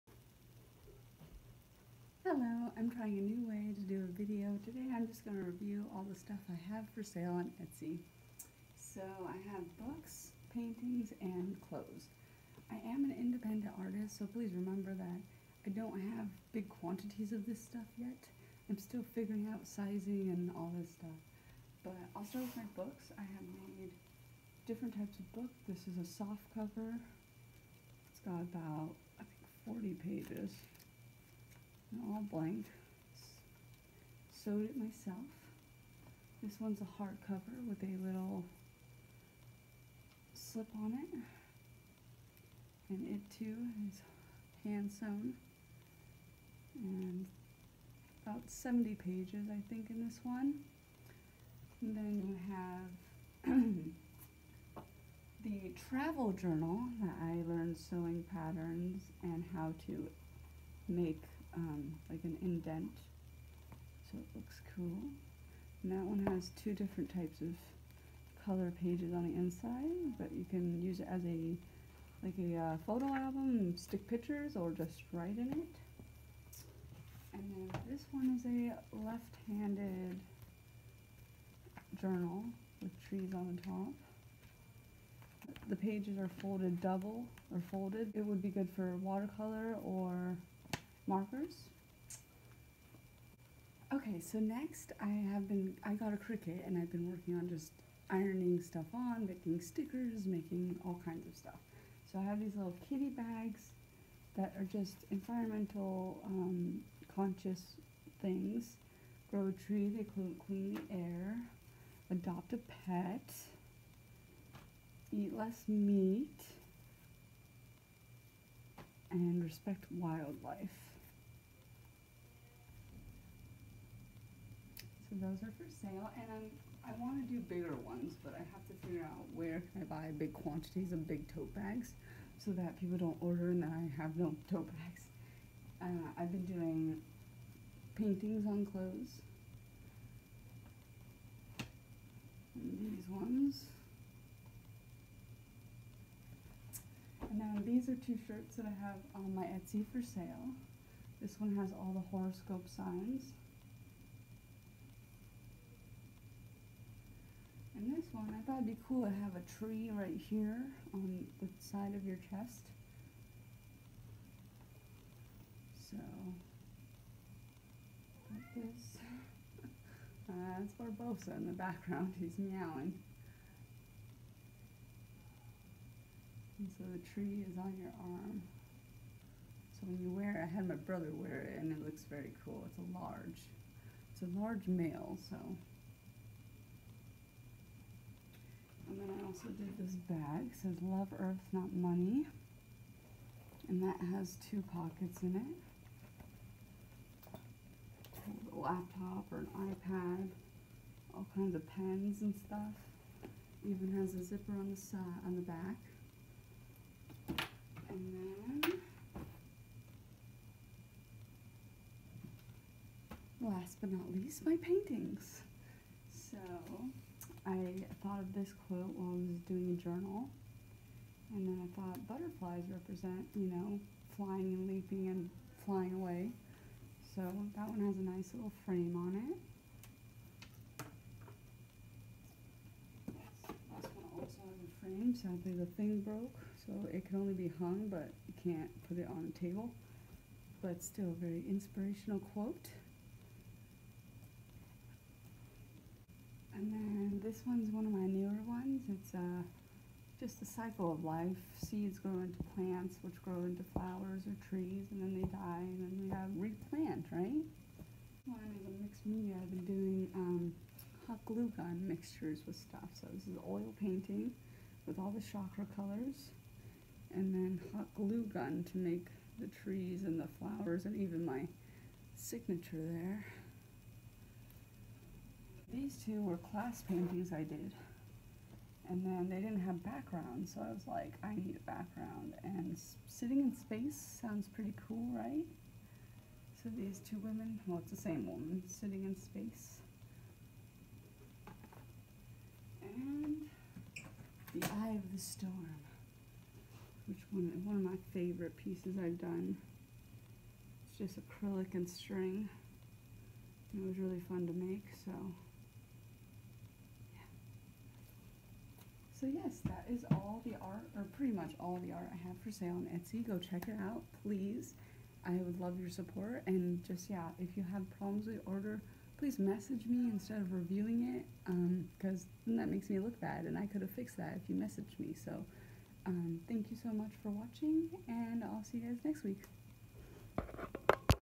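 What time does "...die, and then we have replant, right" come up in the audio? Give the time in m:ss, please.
4:15.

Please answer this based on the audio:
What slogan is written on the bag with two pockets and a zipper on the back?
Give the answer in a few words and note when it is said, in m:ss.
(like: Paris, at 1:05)
Love Earth, Not Money, at 3:10.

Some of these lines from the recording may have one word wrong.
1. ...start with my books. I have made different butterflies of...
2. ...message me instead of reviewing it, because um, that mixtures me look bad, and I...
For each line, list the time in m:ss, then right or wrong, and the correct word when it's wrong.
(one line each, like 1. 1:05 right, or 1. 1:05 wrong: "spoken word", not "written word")
1. 0:22 wrong: "types", not "butterflies"
2. 5:19 wrong: "makes", not "mixtures".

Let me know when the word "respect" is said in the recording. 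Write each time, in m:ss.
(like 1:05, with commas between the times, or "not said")
1:59.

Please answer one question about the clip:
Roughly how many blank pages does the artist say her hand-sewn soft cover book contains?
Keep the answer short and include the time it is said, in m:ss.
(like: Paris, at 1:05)
40, at 0:29.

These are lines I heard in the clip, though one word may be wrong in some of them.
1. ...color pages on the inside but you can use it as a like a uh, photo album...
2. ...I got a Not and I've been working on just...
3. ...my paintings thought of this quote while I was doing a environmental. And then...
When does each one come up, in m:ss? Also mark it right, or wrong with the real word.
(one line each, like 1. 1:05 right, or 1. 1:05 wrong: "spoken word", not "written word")
1. 1:08 right
2. 1:35 wrong: "Cricut", not "Not"
3. 3:34 wrong: "journal", not "environmental".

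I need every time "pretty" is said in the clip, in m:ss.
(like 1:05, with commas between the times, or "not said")
4:44, 5:11.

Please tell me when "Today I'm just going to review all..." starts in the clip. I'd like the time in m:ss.
0:04.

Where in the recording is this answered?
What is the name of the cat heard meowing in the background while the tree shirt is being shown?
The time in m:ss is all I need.
2:50.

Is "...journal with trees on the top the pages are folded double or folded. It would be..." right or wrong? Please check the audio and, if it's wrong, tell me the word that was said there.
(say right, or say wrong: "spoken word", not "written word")
right.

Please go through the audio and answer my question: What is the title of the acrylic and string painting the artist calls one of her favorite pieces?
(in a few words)
The Eye of the Storm.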